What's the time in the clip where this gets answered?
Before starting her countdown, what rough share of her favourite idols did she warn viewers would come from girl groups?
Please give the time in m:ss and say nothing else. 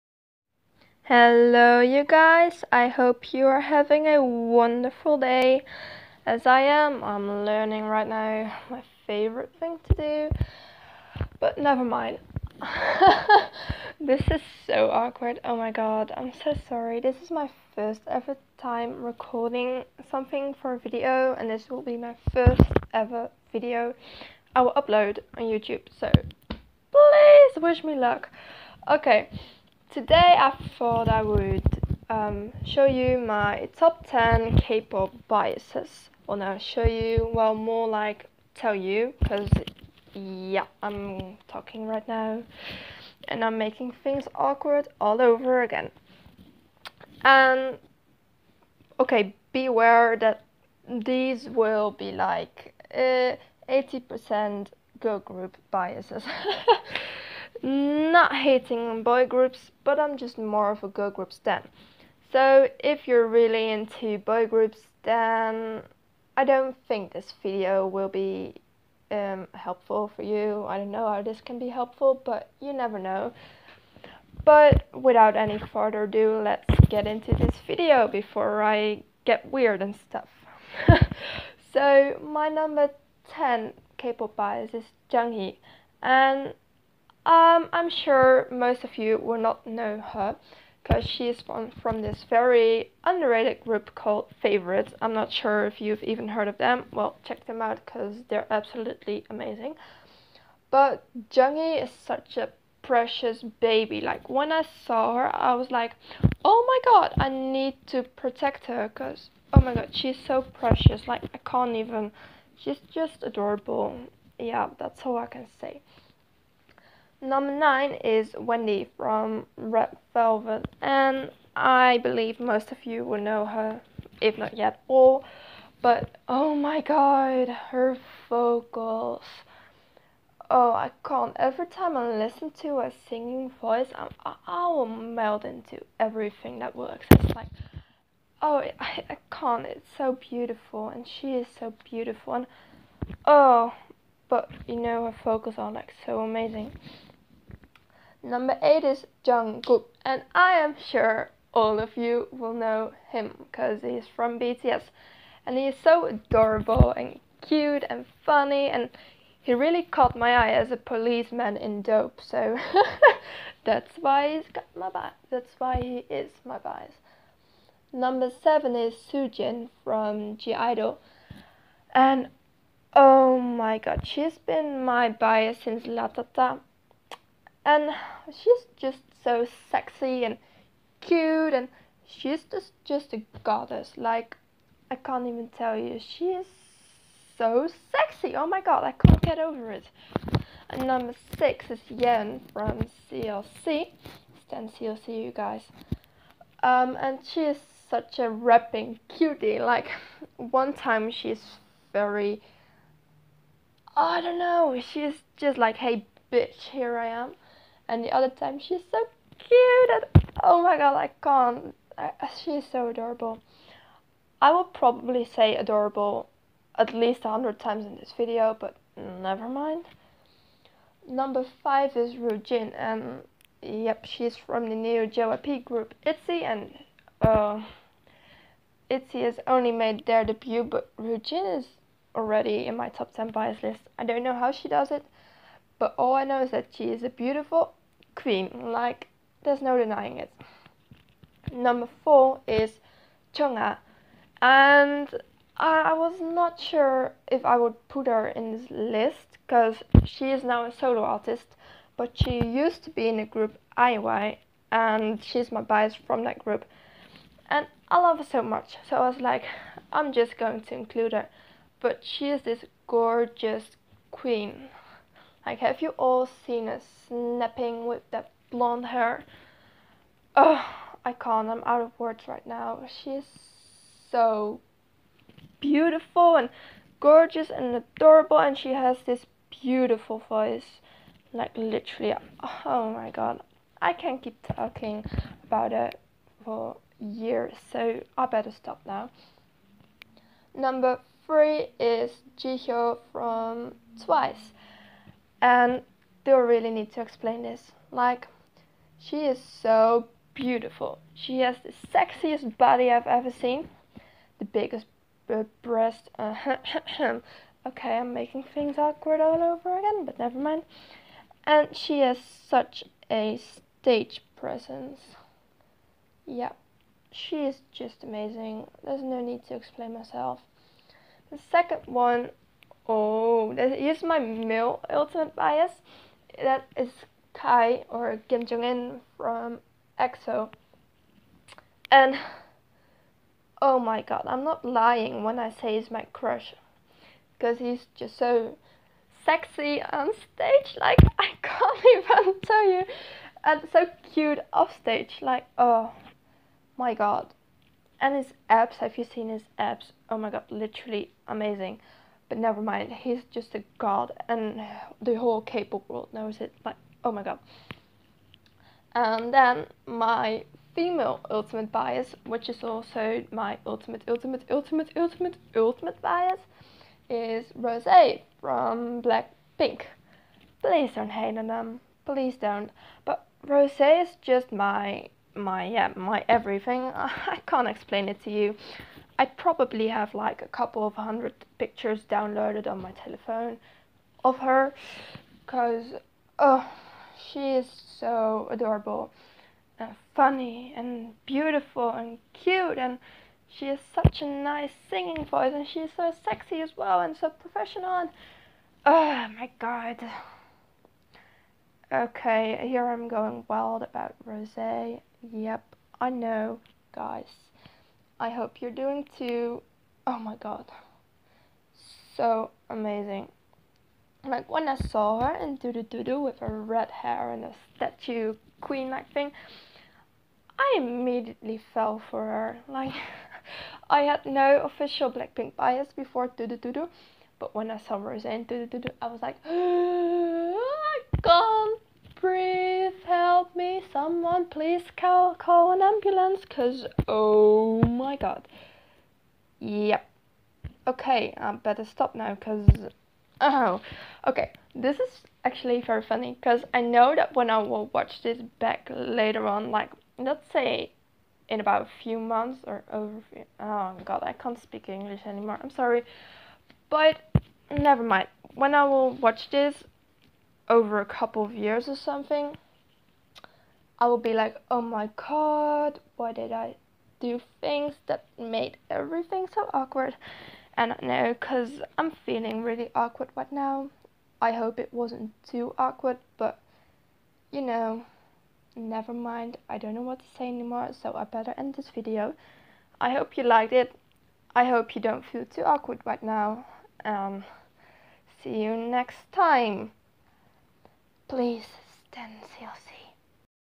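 0:52.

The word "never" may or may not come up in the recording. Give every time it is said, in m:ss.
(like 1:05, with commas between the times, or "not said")
0:11, 1:12, 3:38, 5:10, 5:52, 7:37, 7:58.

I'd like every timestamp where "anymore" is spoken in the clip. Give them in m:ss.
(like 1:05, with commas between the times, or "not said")
7:35, 8:00.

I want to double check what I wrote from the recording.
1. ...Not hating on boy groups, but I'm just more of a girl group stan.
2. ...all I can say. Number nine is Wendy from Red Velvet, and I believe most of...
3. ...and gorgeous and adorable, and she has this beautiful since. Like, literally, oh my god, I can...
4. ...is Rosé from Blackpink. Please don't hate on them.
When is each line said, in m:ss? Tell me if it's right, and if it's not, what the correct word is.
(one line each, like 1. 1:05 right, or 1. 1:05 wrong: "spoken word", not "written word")
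1. 0:57 right
2. 1:55 right
3. 4:36 wrong: "voice", not "since"
4. 6:07 right.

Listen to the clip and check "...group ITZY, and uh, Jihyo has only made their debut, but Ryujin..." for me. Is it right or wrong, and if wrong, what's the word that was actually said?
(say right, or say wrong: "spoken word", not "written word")
wrong: "ITZY", not "Jihyo".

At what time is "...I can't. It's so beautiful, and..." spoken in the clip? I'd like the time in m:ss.
2:19.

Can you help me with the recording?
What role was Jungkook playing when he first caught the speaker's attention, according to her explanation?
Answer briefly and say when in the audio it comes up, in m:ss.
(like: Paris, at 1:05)
Policeman, at 2:40.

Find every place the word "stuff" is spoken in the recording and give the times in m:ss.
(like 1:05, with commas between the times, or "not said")
1:19.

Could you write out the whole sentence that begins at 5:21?
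The second one Oh, is my male ultimate bias.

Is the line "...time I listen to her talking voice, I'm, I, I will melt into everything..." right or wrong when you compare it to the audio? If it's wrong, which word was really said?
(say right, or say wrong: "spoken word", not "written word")
wrong: "singing", not "talking".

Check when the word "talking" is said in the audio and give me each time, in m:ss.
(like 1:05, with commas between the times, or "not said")
0:41, 4:44.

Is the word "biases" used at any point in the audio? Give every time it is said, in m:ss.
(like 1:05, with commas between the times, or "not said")
0:35, 0:55.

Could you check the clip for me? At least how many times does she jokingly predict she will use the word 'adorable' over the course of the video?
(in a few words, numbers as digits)
100.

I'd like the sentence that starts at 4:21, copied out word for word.
But she is this gorgeous queen.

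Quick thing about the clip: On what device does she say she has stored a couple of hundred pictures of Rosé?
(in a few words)
Telephone.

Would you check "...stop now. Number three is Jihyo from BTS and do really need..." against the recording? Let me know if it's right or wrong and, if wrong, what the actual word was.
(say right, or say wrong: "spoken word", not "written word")
wrong: "Twice", not "BTS".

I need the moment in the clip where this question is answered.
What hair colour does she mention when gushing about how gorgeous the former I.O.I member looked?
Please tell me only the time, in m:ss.
4:28.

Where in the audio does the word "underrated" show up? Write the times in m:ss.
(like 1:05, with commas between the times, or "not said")
1:33.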